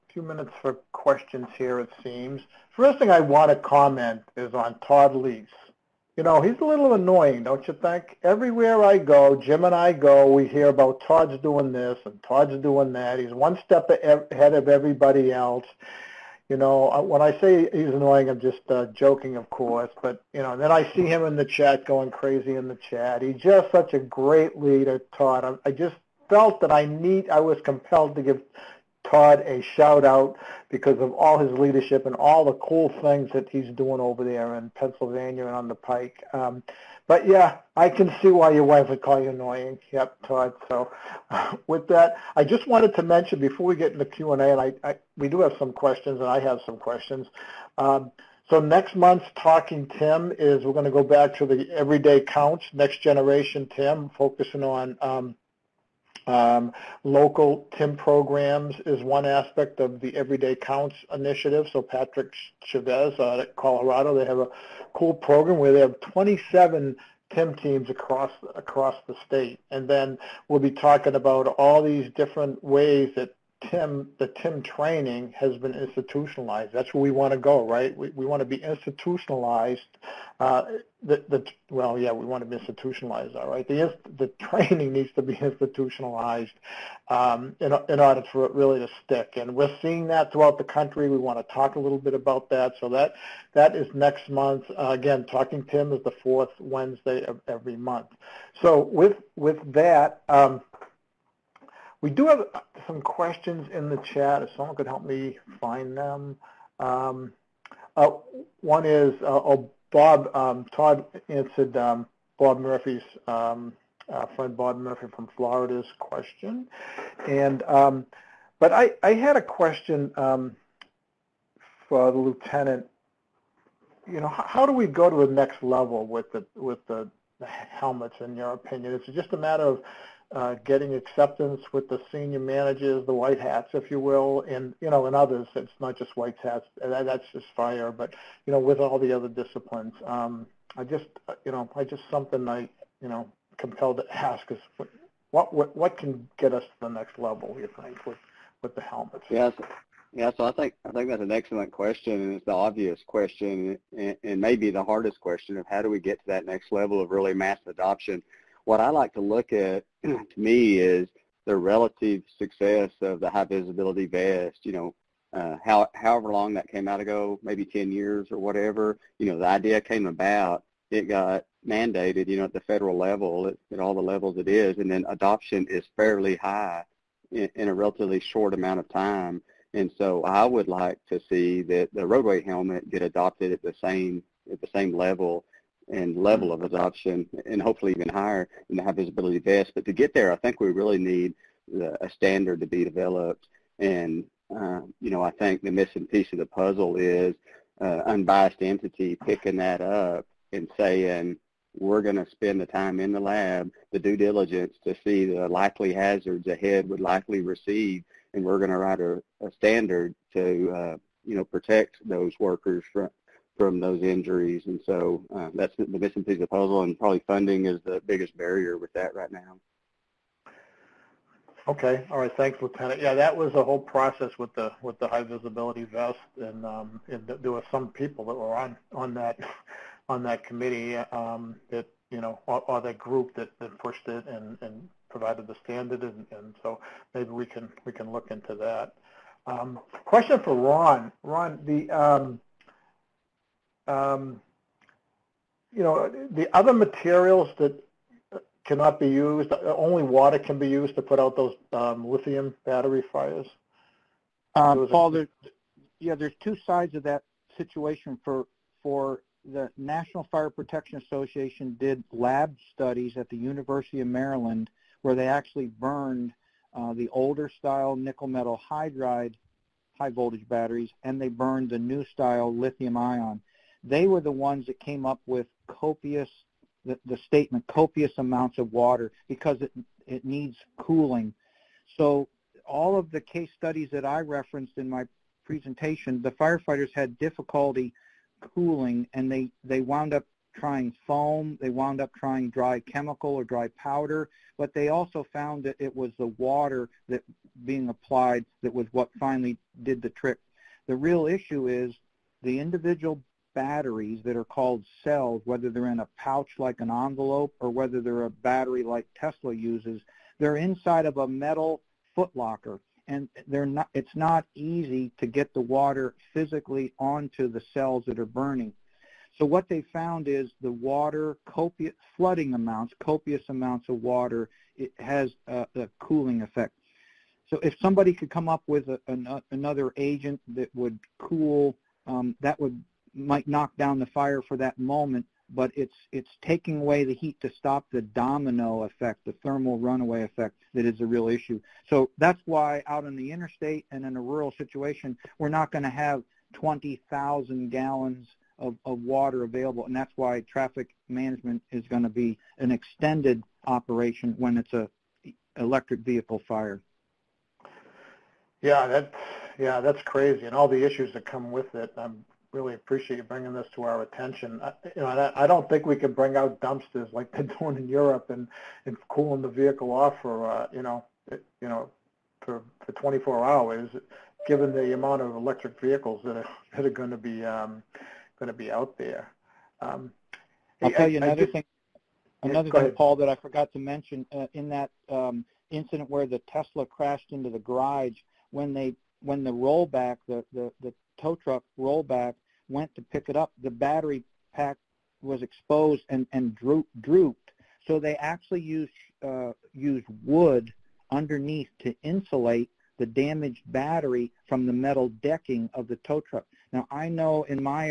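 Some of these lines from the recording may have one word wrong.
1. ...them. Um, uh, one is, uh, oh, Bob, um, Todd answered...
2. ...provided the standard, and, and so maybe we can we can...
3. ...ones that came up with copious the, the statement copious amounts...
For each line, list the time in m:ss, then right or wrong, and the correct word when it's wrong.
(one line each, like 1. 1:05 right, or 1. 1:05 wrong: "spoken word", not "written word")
1. 1:45 right
2. 3:55 right
3. 4:34 right.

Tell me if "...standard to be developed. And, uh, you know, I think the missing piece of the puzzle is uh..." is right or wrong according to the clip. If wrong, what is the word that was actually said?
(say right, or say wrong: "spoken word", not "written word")
right.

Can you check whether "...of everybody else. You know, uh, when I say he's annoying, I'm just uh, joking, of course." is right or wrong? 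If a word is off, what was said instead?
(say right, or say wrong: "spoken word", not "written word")
right.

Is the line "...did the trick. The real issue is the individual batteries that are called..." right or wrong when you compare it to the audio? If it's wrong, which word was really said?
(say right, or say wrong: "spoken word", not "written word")
right.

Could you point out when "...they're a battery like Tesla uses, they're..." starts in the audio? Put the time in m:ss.
5:07.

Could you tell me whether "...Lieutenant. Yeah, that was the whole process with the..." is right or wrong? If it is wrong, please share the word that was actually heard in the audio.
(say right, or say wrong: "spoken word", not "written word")
right.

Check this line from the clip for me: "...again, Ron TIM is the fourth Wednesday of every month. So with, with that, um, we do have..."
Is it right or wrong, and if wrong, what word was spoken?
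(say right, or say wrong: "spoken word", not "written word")
wrong: "Talking", not "Ron".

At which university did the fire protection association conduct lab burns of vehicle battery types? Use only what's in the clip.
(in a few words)
University of Maryland.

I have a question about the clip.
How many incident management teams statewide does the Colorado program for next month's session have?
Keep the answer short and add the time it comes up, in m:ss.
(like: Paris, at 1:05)
27, at 1:06.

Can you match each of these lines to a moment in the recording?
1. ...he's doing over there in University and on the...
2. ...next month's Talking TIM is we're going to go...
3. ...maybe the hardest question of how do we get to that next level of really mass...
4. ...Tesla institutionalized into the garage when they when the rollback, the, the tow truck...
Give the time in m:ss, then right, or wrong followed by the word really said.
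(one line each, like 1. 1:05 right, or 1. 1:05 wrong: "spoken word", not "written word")
1. 0:33 wrong: "Pennsylvania", not "University"
2. 0:48 right
3. 2:34 right
4. 6:26 wrong: "crashed", not "institutionalized".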